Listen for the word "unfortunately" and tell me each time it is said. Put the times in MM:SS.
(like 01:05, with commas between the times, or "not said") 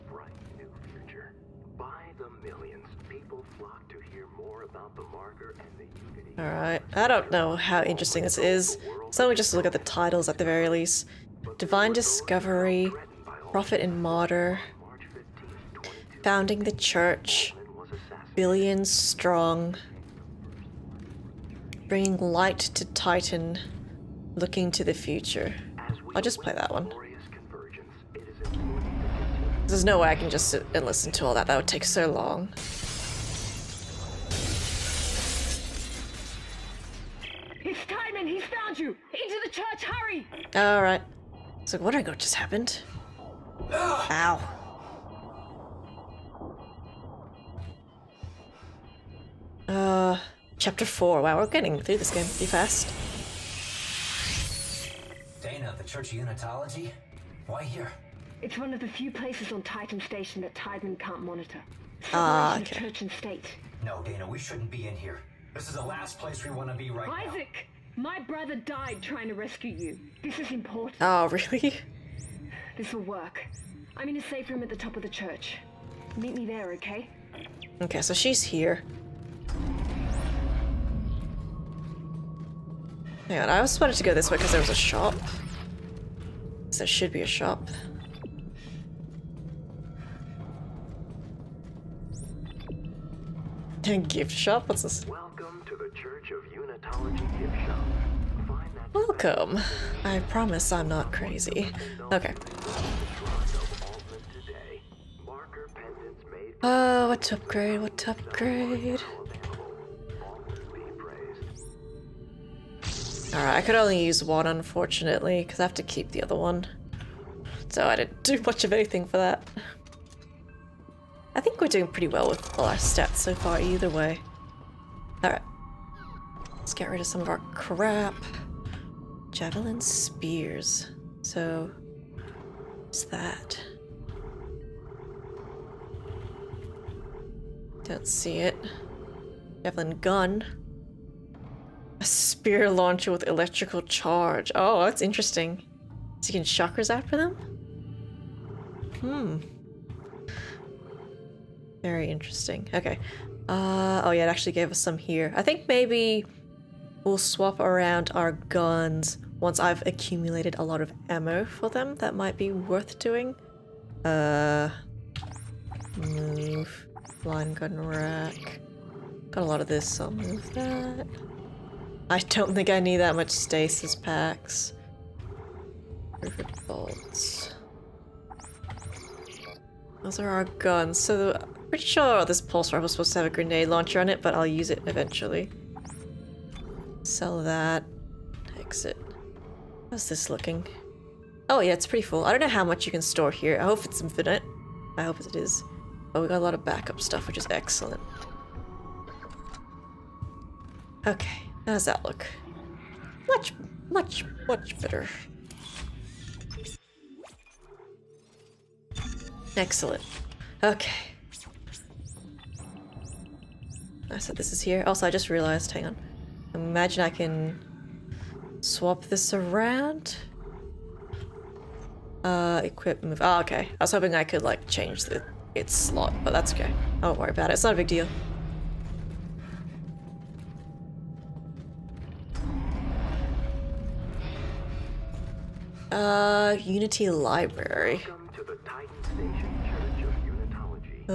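01:54.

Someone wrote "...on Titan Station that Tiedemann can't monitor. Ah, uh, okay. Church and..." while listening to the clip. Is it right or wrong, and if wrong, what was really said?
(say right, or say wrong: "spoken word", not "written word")
right.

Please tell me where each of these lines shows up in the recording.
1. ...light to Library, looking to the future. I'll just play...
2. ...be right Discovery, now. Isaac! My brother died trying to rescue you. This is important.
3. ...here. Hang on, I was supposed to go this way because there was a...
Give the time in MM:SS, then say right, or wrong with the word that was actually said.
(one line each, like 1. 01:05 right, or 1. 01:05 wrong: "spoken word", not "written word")
1. 00:22 wrong: "Titan", not "Library"
2. 01:06 wrong: "Isaac", not "Discovery"
3. 01:18 right.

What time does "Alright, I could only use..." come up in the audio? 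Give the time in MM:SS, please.
01:53.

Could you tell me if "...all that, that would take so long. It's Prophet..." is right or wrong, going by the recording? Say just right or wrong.
wrong.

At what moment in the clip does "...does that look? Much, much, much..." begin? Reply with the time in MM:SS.
03:21.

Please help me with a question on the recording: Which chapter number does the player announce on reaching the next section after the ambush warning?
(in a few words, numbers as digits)
4.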